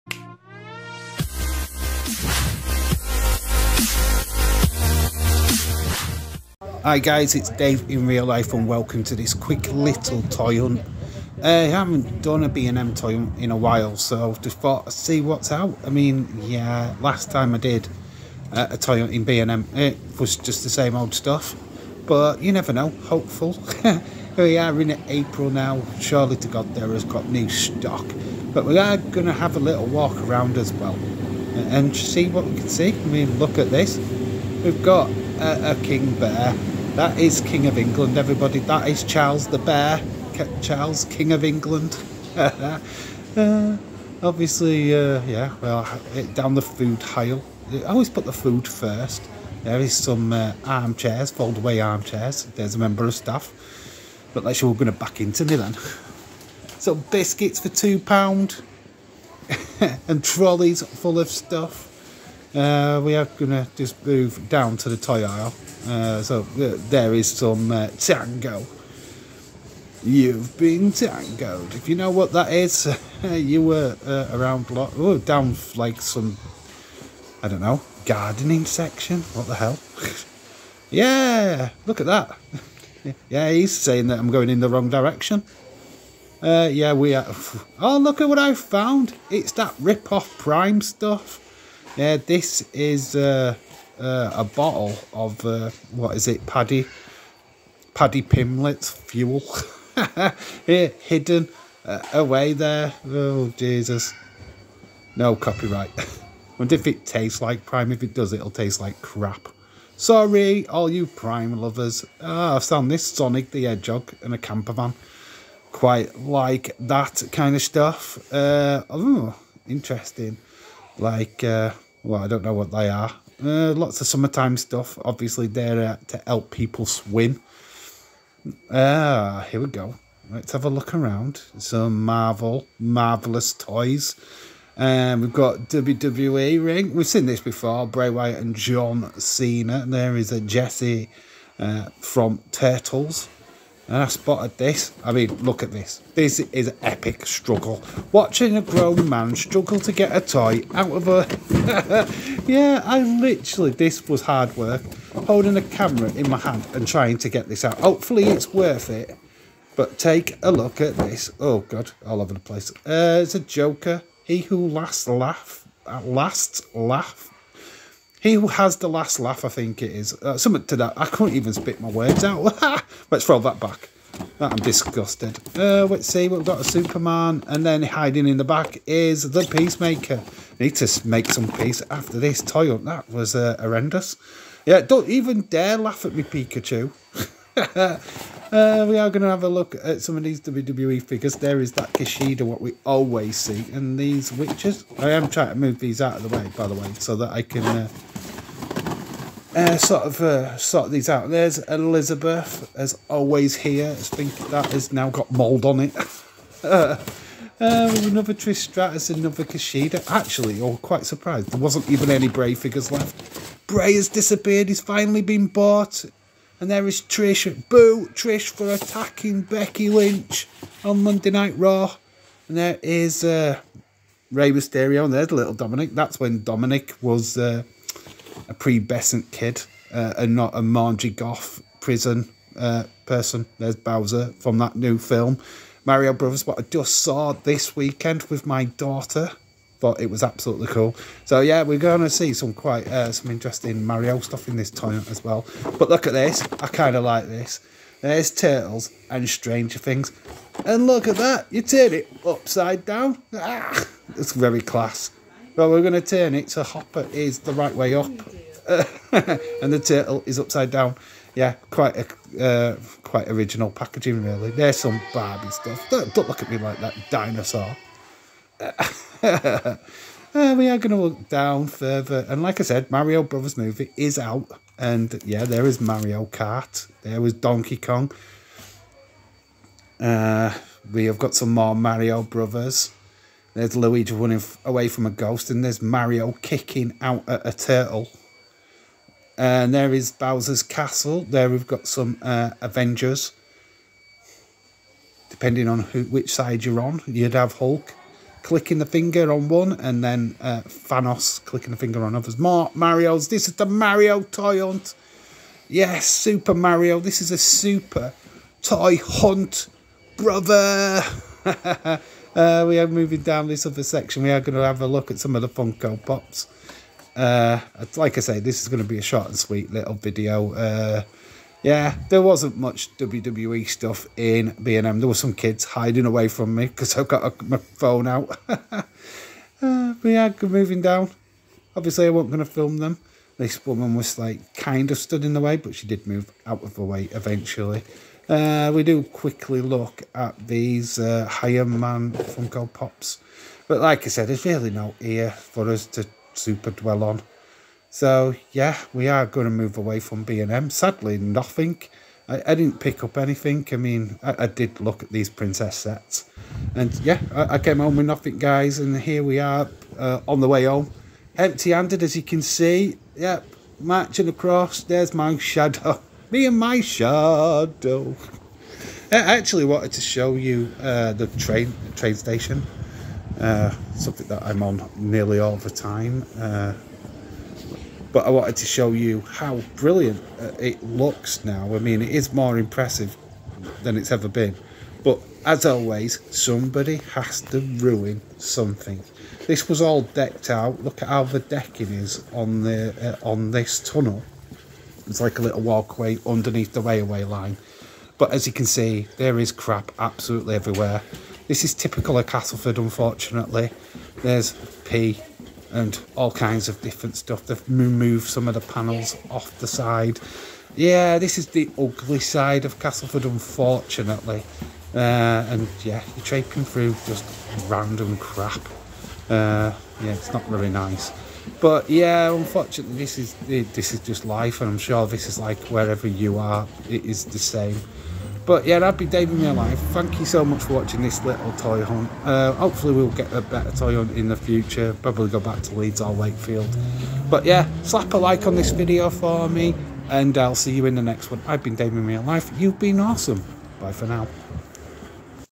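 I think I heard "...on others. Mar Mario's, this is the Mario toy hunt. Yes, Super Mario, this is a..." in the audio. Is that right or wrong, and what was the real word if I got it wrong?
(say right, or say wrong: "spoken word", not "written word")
right.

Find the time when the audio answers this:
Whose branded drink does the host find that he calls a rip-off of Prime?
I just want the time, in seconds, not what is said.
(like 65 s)
97 s.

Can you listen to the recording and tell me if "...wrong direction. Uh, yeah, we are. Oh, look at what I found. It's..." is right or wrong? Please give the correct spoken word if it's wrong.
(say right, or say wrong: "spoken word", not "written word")
right.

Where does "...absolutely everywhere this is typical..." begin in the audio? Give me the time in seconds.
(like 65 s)
399 s.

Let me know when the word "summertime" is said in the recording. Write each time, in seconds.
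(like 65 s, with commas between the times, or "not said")
124 s.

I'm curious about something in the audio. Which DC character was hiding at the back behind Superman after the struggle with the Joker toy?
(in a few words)
Peacemaker.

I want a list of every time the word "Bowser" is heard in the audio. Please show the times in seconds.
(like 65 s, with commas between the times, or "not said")
233 s, 290 s.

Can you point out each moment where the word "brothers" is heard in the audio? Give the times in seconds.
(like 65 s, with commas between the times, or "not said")
236 s, 273 s, 282 s, 310 s.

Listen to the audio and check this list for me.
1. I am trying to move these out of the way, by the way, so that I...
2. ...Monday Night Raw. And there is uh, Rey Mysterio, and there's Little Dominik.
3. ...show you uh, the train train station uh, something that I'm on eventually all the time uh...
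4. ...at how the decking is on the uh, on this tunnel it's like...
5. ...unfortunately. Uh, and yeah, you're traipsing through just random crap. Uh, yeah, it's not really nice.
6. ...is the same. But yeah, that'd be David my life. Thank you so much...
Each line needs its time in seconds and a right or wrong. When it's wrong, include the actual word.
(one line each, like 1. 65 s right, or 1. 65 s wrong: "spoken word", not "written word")
1. 194 s right
2. 221 s right
3. 370 s wrong: "nearly", not "eventually"
4. 391 s right
5. 413 s right
6. 427 s right.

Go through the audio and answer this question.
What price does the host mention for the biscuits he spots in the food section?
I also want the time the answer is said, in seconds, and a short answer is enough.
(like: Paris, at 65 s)
£2, at 57 s.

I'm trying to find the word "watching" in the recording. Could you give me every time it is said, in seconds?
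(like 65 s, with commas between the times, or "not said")
148 s, 430 s.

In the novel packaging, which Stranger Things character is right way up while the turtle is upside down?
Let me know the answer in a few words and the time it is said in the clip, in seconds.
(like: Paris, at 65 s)
Hopper, at 256 s.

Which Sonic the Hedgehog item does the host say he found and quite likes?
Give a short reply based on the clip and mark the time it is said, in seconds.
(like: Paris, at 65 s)
A camper van, at 114 s.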